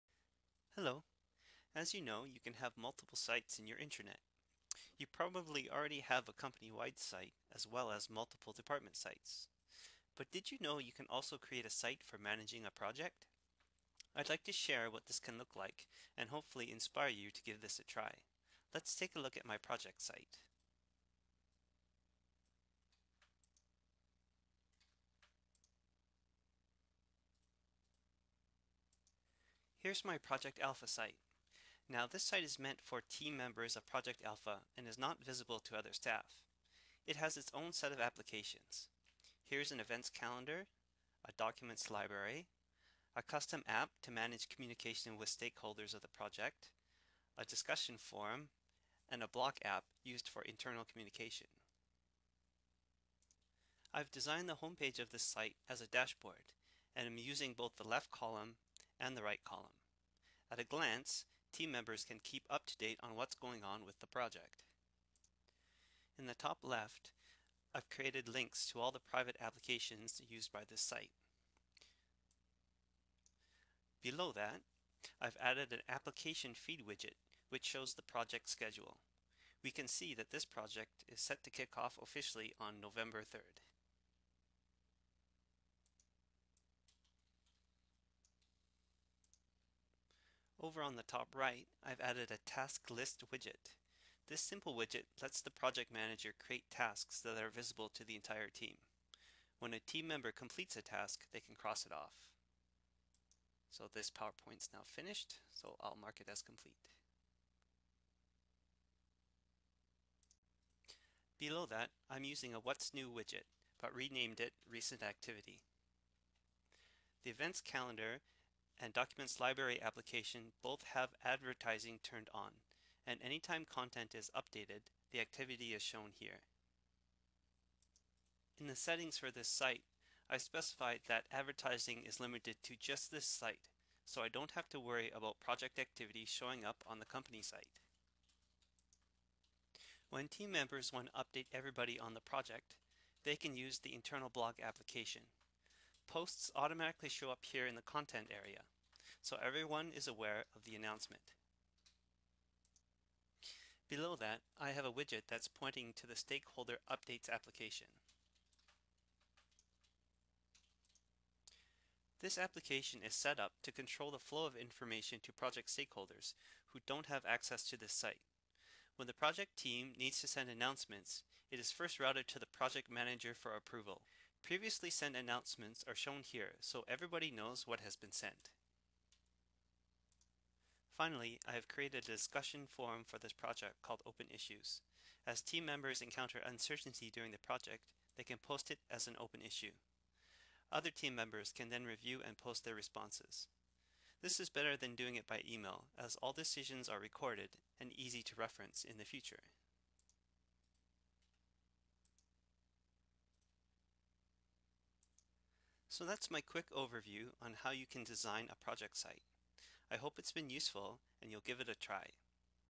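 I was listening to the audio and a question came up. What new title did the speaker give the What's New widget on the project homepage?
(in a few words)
Recent Activity.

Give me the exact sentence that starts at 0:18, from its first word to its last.
Let's take a look at my project site.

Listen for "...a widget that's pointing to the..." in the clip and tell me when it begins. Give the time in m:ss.
2:34.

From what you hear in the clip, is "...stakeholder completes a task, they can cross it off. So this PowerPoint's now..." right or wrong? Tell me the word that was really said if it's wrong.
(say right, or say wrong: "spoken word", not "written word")
wrong: "member", not "stakeholder".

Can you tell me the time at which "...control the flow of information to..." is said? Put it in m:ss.
2:43.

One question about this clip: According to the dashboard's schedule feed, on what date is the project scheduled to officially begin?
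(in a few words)
November 3rd.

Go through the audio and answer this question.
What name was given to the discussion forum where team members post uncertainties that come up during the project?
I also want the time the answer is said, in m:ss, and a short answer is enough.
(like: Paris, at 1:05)
Open Issues, at 3:04.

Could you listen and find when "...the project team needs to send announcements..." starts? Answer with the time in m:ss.
2:49.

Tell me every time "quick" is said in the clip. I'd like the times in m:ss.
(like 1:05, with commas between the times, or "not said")
3:26.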